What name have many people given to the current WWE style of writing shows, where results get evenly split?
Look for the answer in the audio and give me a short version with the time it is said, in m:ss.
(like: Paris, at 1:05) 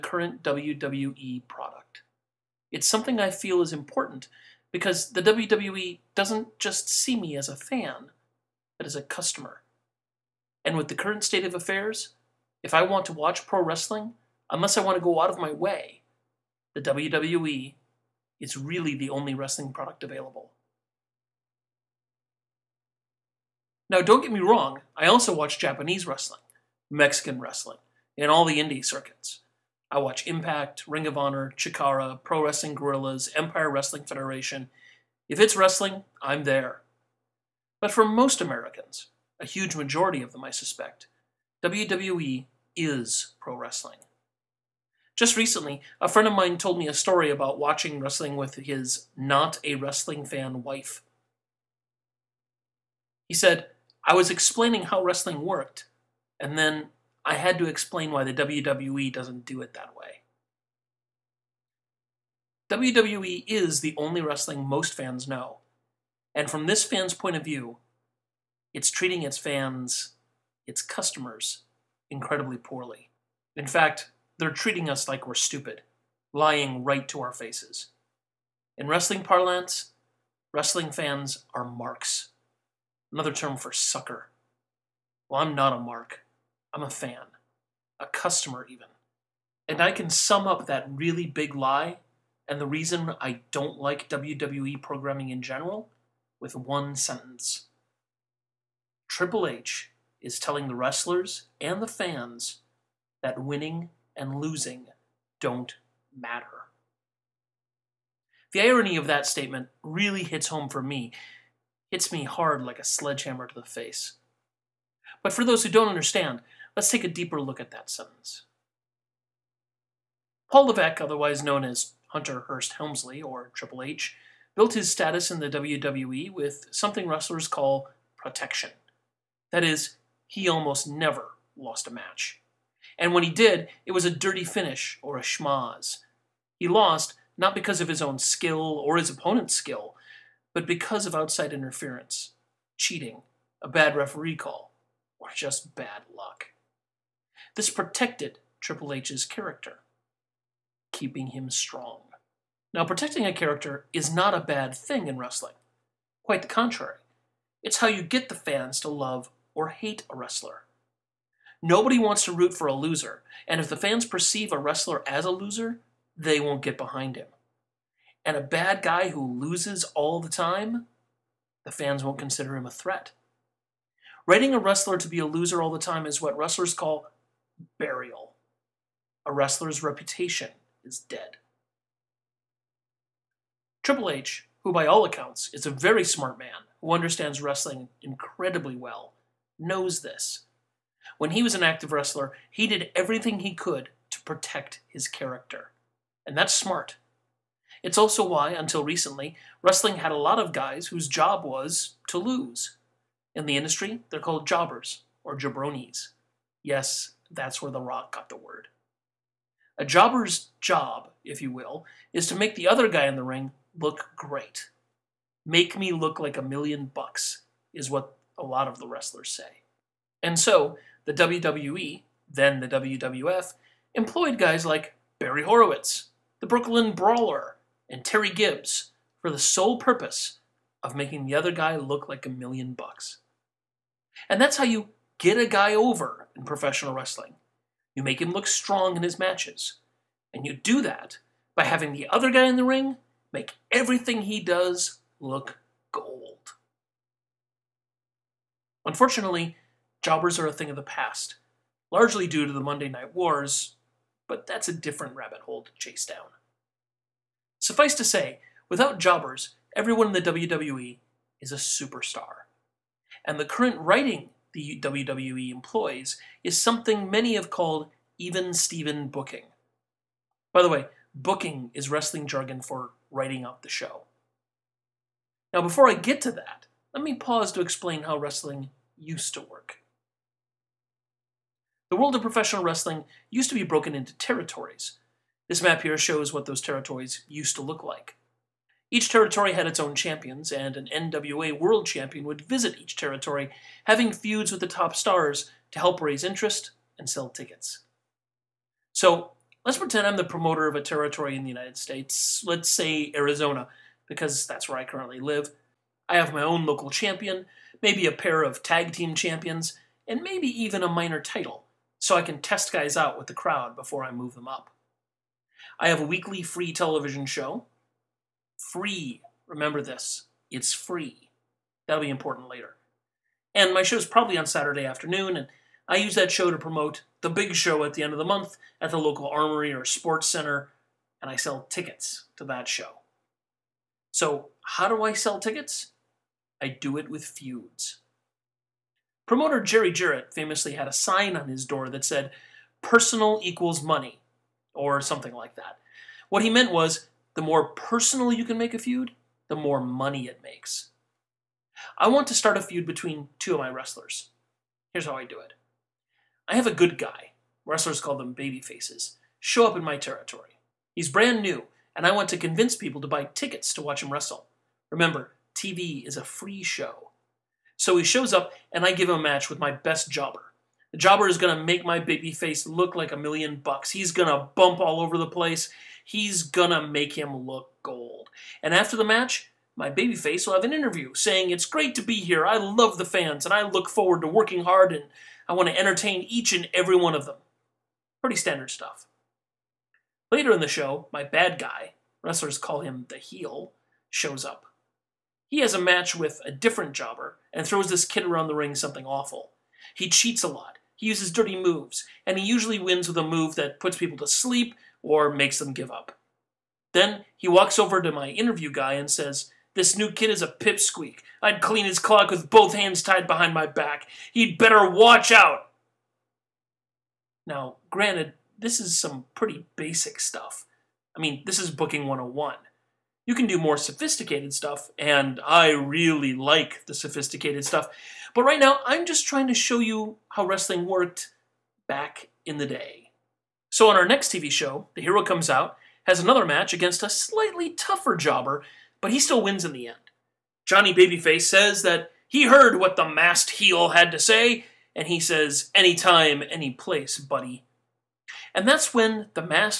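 Even Steven booking, at 4:28.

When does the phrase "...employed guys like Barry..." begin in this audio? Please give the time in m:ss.
3:43.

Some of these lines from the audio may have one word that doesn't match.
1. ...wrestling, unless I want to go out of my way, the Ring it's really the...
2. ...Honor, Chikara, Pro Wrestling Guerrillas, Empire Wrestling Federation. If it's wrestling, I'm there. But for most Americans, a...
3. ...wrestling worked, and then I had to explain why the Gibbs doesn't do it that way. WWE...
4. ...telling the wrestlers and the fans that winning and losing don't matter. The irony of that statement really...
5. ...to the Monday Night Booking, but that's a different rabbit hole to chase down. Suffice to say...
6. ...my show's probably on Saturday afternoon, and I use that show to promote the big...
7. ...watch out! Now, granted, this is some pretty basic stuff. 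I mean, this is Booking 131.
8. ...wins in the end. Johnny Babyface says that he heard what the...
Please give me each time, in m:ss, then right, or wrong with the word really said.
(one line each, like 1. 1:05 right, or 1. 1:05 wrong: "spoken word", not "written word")
1. 0:13 wrong: "WWE", not "Ring"
2. 0:31 right
3. 0:55 wrong: "WWE", not "Gibbs"
4. 1:40 right
5. 4:12 wrong: "Wars", not "Booking"
6. 5:23 right
7. 6:54 wrong: "101", not "131"
8. 7:19 right.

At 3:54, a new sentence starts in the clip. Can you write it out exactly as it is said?
And that's how you get a guy over in professional wrestling.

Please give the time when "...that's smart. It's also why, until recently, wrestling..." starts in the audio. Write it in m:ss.
3:16.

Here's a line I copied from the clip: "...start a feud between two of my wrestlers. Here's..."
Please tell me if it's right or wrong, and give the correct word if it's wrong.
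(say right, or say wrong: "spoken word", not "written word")
right.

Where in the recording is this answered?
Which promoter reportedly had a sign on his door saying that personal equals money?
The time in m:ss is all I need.
5:39.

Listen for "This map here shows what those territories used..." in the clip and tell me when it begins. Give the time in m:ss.
4:45.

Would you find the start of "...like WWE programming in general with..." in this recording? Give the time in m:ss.
1:33.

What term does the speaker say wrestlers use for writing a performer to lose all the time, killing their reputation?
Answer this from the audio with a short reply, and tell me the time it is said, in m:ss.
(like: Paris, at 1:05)
Burial, at 2:57.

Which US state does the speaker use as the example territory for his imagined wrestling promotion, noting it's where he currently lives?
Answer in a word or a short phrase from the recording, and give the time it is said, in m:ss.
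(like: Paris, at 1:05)
Arizona, at 5:03.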